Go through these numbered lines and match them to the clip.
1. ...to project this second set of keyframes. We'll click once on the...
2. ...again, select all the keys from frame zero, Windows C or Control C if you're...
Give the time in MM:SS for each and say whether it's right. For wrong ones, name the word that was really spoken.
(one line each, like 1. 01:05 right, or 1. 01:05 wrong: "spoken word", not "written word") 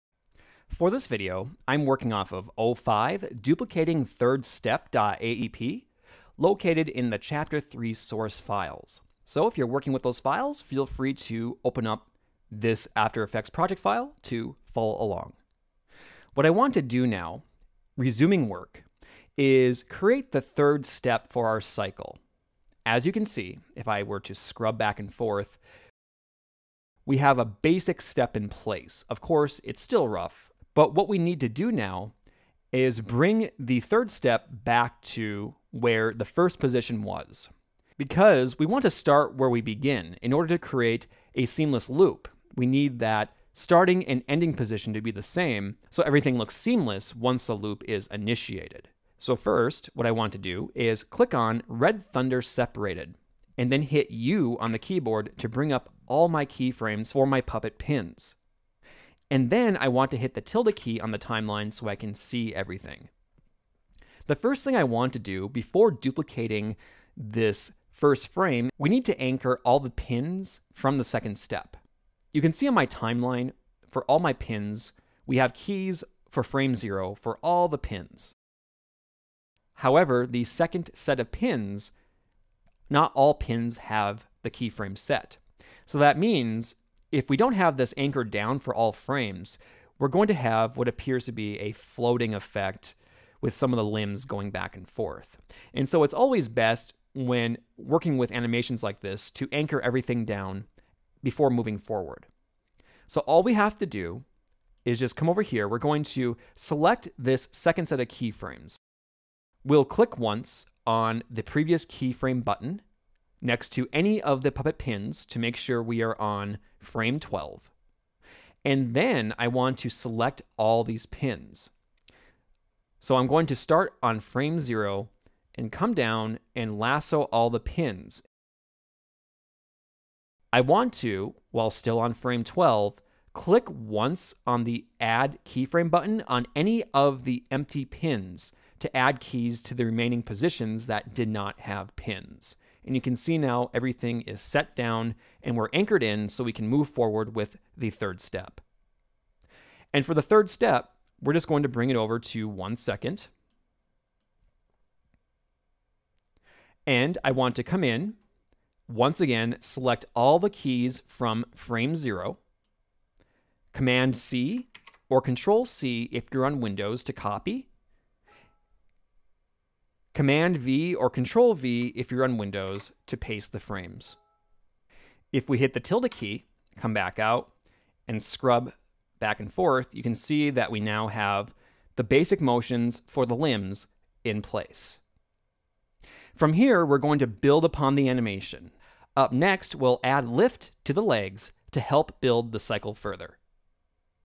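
1. 01:46 wrong: "select", not "project"
2. 02:39 wrong: "Command", not "Windows".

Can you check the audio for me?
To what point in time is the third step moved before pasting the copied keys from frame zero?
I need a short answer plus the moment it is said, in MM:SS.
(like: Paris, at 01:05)
1 second, at 02:32.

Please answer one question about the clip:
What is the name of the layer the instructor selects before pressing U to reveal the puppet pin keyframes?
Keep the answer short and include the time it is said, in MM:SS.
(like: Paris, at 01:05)
Red Thunder Separated, at 00:51.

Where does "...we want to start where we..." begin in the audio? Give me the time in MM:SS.
00:38.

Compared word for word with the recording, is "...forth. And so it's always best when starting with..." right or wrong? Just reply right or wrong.
wrong.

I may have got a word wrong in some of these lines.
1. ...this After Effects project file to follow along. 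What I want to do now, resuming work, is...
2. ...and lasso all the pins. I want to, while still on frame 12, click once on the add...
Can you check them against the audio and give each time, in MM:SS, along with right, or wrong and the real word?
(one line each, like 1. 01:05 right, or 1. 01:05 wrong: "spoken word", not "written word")
1. 00:12 right
2. 02:06 right.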